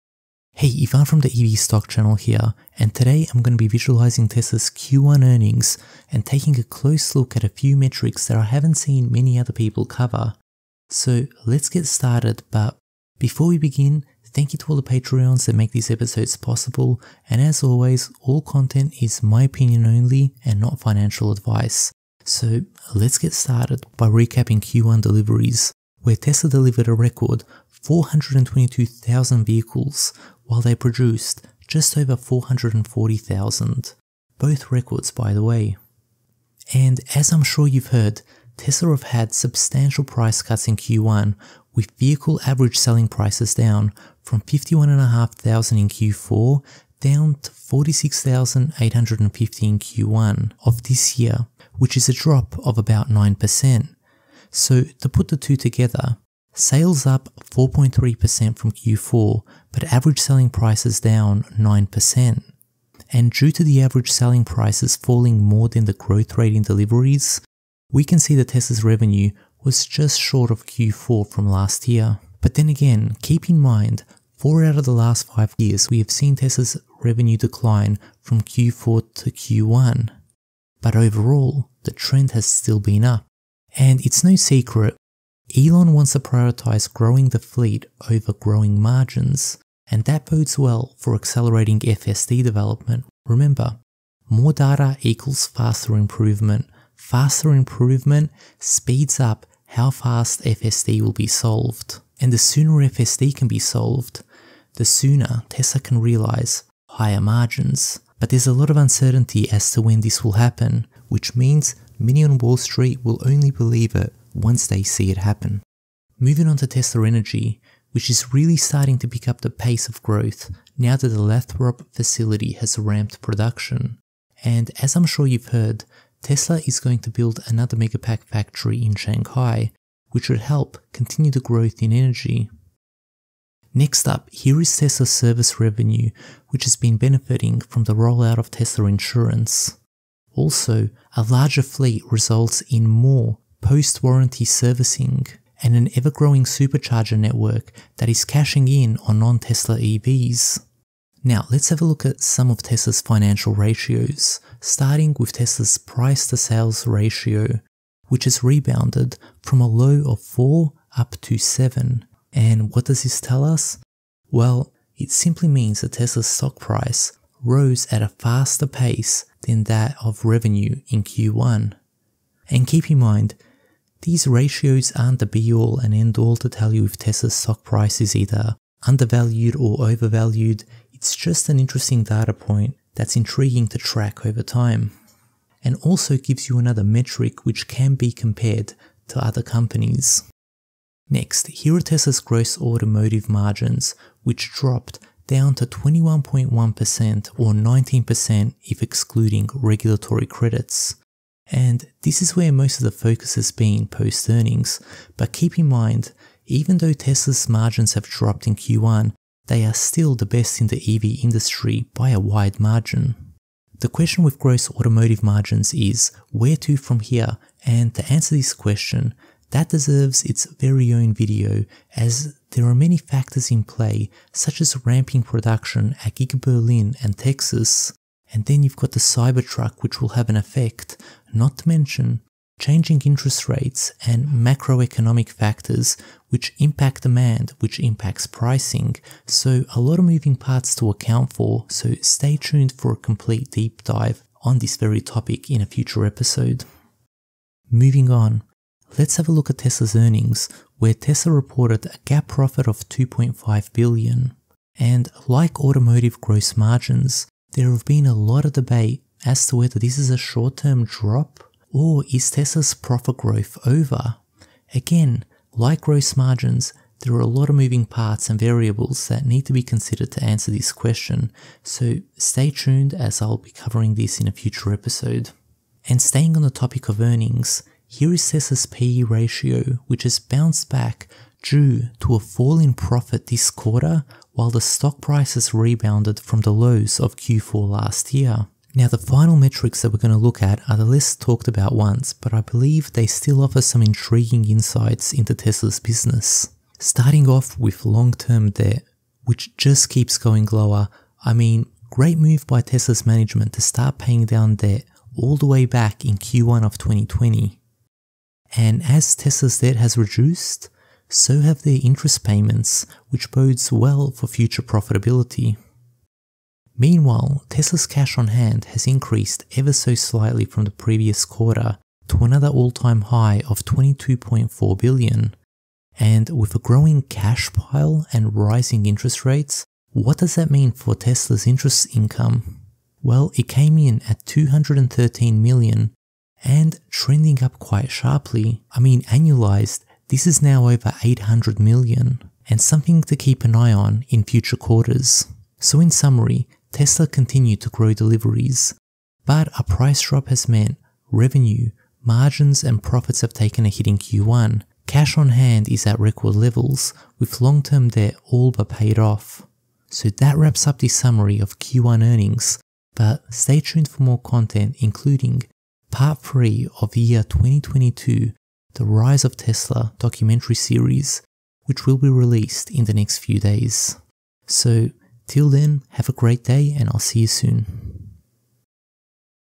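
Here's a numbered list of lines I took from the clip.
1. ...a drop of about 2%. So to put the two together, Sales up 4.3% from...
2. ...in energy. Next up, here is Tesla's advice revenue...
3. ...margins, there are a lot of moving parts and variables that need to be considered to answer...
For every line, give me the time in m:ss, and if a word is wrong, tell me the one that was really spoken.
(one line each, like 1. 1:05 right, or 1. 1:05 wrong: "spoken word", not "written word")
1. 0:52 wrong: "9", not "2"
2. 2:11 wrong: "service", not "advice"
3. 4:26 right.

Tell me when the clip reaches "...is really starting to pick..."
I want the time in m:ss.
1:58.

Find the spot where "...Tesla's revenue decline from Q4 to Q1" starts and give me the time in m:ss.
1:16.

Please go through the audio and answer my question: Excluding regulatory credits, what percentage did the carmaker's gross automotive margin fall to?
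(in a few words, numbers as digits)
19%.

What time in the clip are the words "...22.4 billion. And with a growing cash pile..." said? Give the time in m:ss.
5:23.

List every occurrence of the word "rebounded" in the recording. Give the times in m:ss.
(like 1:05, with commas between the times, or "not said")
2:38, 4:45.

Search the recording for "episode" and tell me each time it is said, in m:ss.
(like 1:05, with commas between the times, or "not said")
0:15, 4:06, 4:34.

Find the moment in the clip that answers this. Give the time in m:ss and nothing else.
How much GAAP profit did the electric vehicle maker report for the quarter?
4:12.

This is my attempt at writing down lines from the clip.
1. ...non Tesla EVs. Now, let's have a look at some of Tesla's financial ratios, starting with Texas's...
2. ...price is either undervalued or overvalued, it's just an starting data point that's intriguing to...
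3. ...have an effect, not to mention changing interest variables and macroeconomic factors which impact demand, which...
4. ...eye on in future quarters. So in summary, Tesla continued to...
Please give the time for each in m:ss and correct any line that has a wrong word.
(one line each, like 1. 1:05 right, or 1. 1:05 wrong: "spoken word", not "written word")
1. 2:29 wrong: "Tesla", not "Texas"
2. 2:57 wrong: "interesting", not "starting"
3. 3:50 wrong: "rates", not "variables"
4. 5:43 right.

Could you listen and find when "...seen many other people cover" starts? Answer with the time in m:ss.
0:08.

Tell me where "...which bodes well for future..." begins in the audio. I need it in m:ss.
5:13.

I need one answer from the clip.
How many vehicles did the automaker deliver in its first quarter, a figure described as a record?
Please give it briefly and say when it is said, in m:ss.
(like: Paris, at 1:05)
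422,000, at 0:27.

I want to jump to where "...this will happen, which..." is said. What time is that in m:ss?
1:50.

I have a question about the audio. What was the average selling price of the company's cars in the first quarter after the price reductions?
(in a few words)
46,850.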